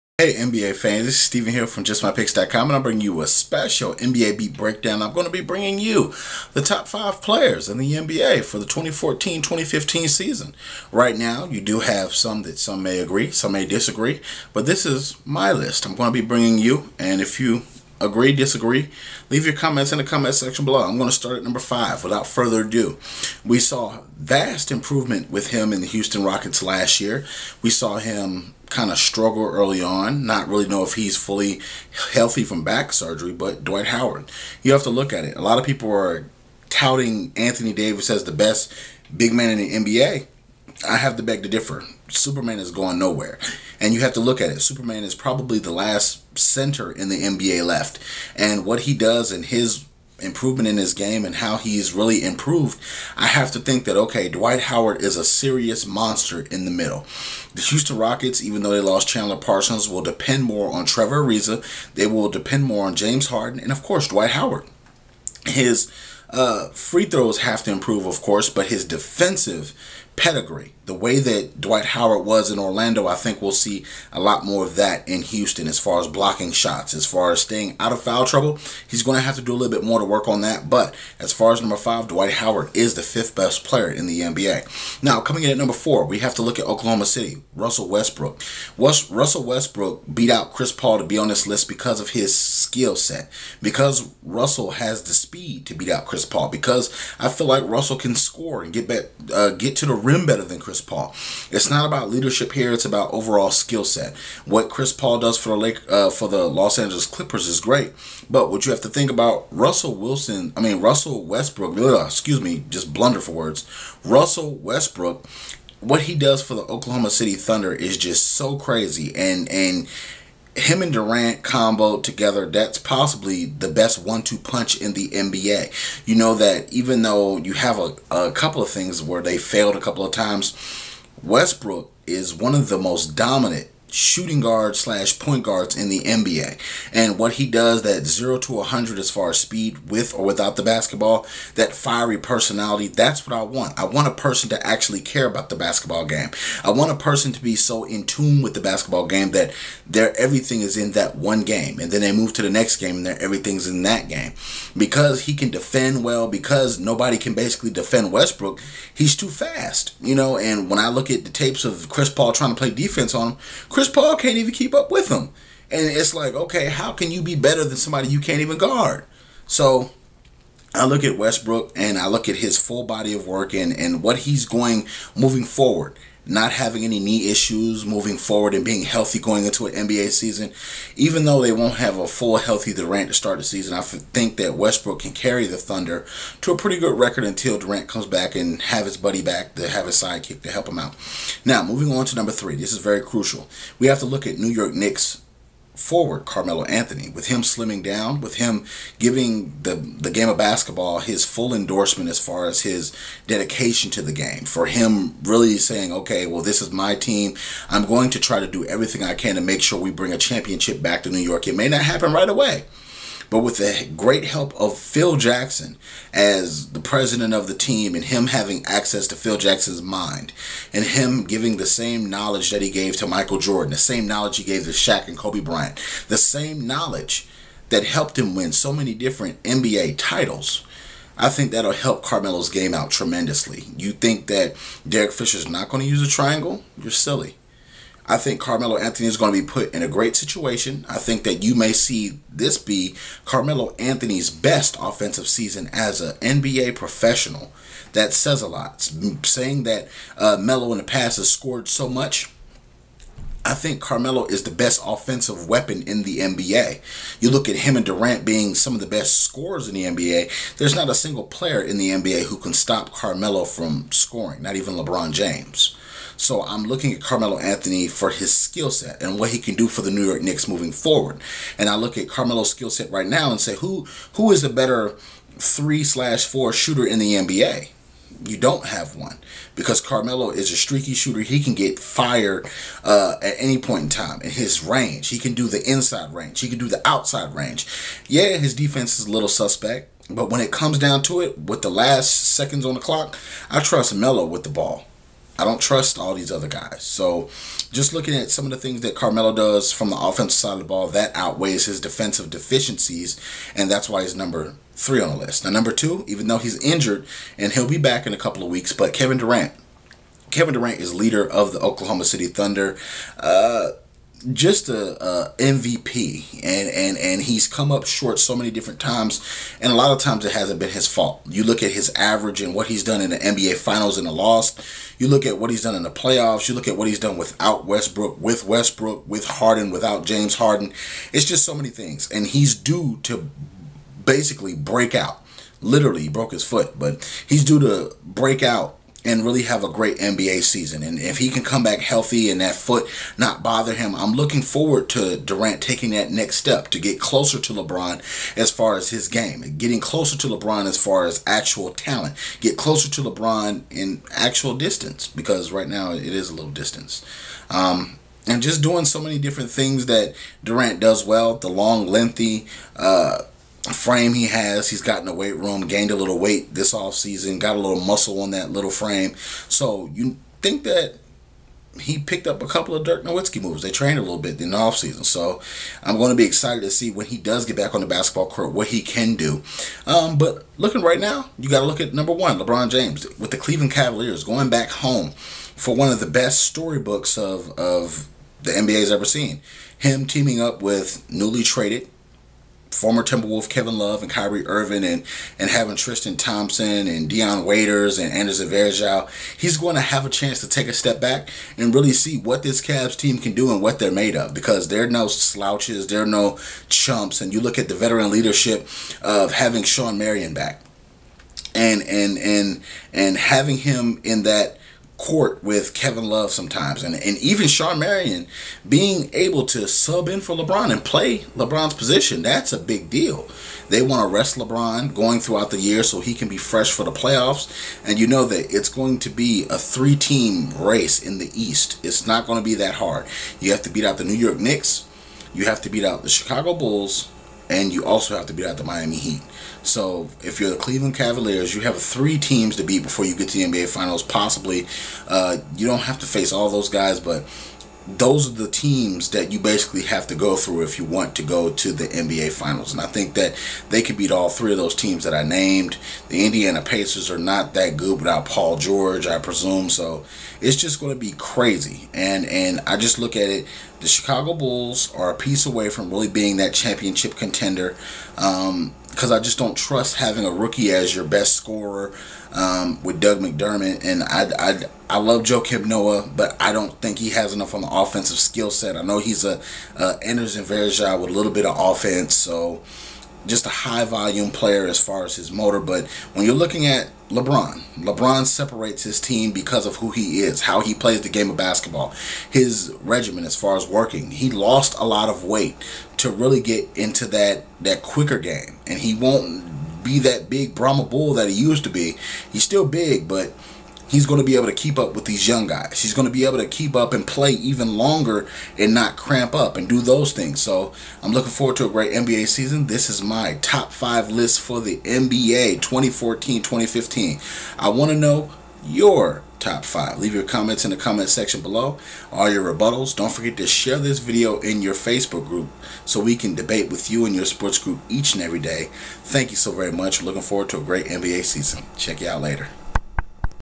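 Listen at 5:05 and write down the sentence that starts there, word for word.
Now, number two, even though he's injured and he'll be back in a couple of weeks, but Kevin Durant.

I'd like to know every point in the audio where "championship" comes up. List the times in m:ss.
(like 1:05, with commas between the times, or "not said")
3:30, 7:46.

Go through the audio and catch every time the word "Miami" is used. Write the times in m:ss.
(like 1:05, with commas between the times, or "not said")
7:18.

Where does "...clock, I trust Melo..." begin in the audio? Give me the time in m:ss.
4:52.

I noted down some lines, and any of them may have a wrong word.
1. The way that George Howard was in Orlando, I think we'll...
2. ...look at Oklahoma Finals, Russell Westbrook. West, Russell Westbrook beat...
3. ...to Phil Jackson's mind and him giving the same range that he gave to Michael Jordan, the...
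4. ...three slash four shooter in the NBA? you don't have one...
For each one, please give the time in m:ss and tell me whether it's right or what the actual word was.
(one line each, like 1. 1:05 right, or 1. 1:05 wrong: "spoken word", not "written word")
1. 1:10 wrong: "Dwight", not "George"
2. 1:26 wrong: "City", not "Finals"
3. 3:39 wrong: "knowledge", not "range"
4. 4:35 right.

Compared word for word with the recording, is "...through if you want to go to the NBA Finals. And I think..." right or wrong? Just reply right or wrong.
right.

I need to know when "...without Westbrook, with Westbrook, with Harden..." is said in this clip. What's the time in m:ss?
5:27.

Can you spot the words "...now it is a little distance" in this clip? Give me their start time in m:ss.
5:55.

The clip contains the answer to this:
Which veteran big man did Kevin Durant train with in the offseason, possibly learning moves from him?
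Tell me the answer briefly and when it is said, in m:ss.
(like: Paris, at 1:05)
Dirk Nowitzki, at 6:12.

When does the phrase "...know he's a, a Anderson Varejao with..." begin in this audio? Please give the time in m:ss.
7:58.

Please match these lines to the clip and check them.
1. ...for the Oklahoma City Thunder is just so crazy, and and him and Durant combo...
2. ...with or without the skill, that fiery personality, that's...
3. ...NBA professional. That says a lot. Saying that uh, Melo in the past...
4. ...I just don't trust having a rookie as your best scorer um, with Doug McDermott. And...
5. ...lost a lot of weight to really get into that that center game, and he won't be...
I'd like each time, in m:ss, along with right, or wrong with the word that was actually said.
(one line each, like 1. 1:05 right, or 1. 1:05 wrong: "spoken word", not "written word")
1. 1:56 right
2. 2:19 wrong: "basketball", not "skill"
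3. 4:06 right
4. 7:49 right
5. 8:14 wrong: "quicker", not "center".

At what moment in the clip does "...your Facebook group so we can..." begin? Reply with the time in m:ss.
8:44.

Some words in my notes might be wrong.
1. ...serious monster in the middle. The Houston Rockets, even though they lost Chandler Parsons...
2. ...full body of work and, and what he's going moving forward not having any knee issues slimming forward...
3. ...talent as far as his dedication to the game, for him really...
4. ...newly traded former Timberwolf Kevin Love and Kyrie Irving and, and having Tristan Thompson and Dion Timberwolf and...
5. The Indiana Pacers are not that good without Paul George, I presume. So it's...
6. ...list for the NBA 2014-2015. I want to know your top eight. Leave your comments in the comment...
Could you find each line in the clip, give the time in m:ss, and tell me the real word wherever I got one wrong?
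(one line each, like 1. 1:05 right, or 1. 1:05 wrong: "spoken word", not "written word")
1. 0:55 right
2. 2:52 wrong: "moving", not "slimming"
3. 3:21 wrong: "endorsement", not "talent"
4. 6:31 wrong: "Waiters", not "Timberwolf"
5. 7:36 right
6. 8:34 wrong: "five", not "eight".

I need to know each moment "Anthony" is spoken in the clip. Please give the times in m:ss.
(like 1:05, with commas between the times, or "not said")
0:37, 3:16, 3:58, 4:03, 4:27.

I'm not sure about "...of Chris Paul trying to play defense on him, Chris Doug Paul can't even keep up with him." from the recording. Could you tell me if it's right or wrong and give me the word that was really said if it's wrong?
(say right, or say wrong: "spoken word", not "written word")
wrong: "Chris", not "Doug".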